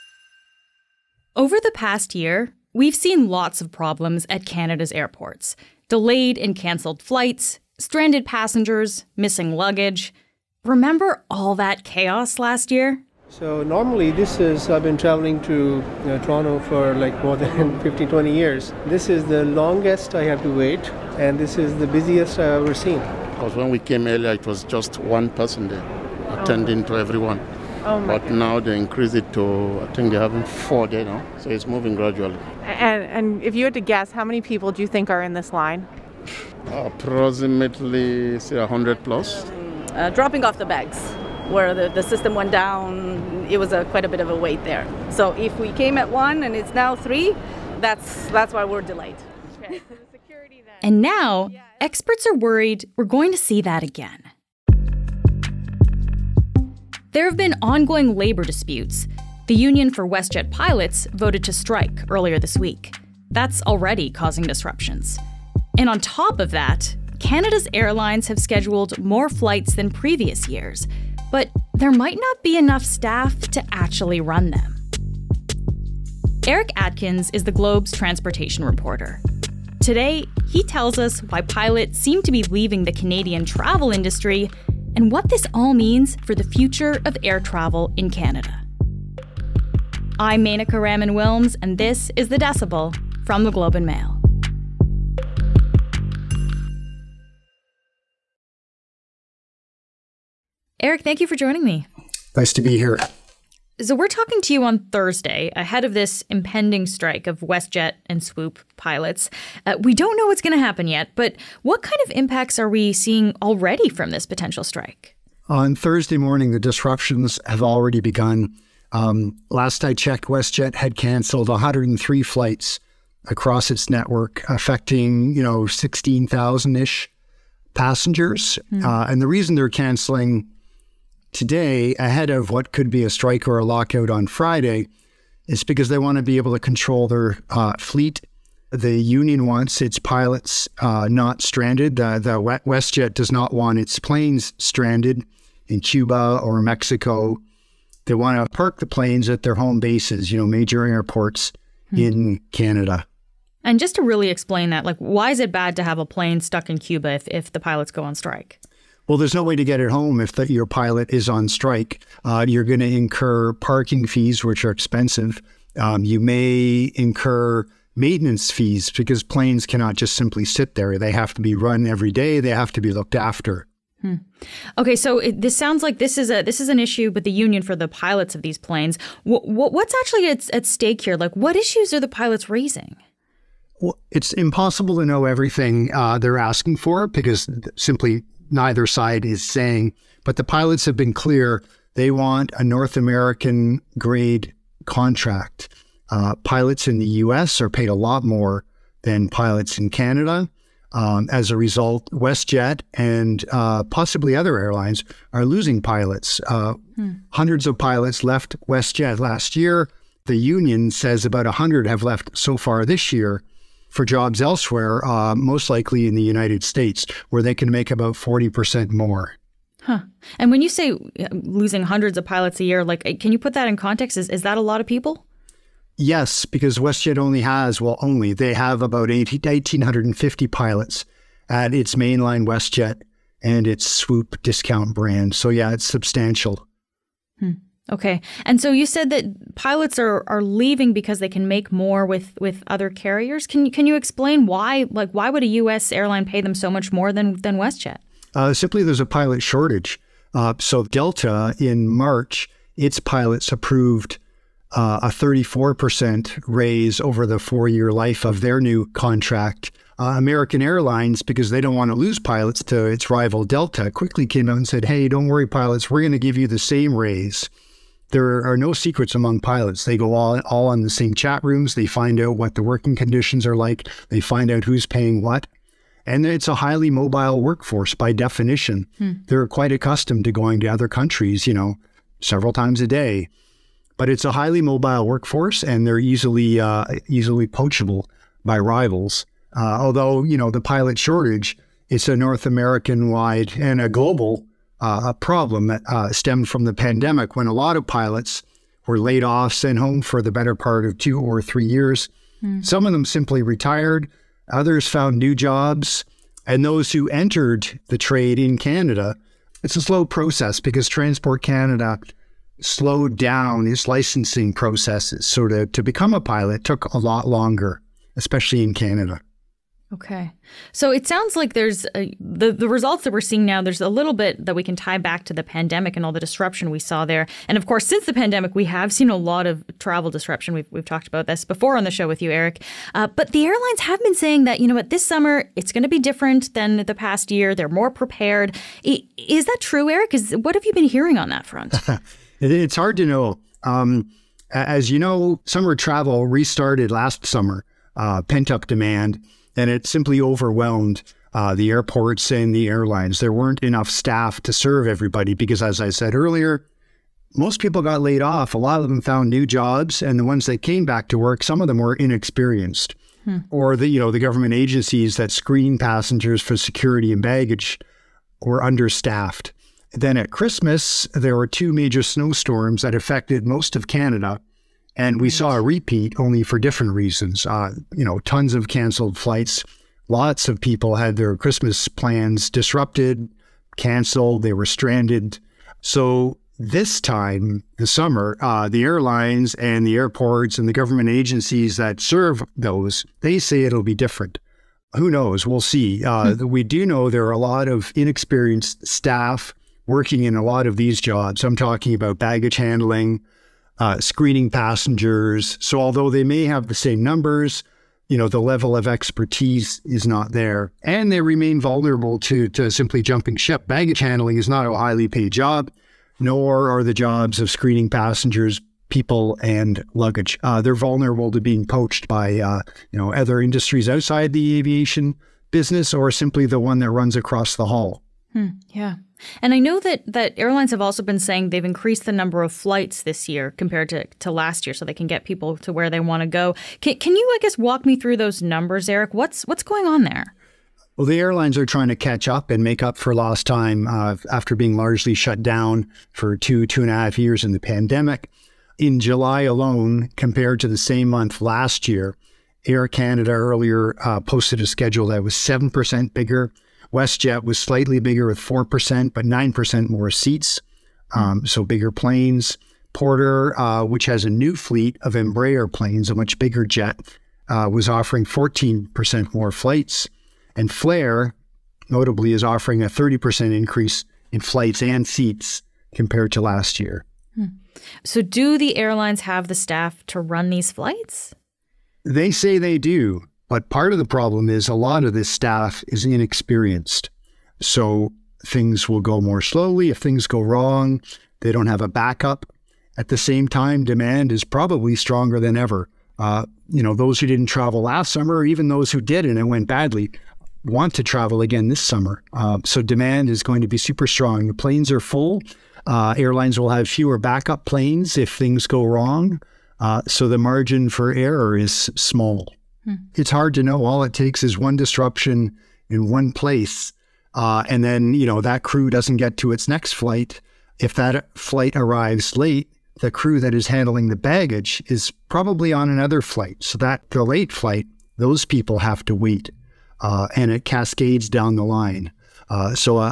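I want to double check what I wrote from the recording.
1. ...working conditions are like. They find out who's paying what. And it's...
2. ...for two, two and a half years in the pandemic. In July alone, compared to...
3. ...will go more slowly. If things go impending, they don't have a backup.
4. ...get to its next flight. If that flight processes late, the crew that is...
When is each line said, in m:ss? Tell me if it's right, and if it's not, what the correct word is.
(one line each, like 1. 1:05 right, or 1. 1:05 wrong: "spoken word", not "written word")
1. 4:32 right
2. 7:26 right
3. 8:08 wrong: "wrong", not "impending"
4. 8:39 wrong: "arrives", not "processes".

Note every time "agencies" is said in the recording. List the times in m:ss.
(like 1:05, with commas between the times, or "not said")
6:04, 6:31.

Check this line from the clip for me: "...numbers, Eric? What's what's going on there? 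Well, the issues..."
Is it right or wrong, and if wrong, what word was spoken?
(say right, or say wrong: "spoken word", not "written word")
wrong: "airlines", not "issues".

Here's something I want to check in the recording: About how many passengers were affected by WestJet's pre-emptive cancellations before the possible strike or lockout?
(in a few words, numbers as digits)
16,000.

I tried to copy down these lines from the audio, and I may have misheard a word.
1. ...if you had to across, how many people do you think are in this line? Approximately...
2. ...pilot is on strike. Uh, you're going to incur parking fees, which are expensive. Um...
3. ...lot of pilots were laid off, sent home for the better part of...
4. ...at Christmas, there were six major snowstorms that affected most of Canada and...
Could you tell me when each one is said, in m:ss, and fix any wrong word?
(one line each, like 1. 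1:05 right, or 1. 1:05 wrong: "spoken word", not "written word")
1. 0:33 wrong: "guess", not "across"
2. 2:40 right
3. 4:57 right
4. 6:10 wrong: "two", not "six".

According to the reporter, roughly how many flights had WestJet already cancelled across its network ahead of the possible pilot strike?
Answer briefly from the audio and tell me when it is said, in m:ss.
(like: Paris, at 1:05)
103, at 2:01.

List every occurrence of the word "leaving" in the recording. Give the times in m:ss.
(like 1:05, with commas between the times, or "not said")
1:22, 4:00.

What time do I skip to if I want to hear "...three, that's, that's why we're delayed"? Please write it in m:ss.
0:46.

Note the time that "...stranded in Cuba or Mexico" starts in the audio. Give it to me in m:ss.
2:24.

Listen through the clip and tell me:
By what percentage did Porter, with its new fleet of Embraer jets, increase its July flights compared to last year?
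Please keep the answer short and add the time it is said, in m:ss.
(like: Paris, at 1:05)
14%, at 7:48.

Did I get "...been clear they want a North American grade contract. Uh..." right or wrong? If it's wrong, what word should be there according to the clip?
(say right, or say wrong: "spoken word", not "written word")
right.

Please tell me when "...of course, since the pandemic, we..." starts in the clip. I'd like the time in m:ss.
5:27.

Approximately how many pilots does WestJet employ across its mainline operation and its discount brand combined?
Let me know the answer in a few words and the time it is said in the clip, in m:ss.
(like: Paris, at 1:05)
1,850, at 3:49.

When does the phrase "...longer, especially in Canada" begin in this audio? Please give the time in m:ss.
5:17.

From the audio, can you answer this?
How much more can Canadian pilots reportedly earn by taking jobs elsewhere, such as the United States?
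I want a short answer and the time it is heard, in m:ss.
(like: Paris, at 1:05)
40%, at 3:38.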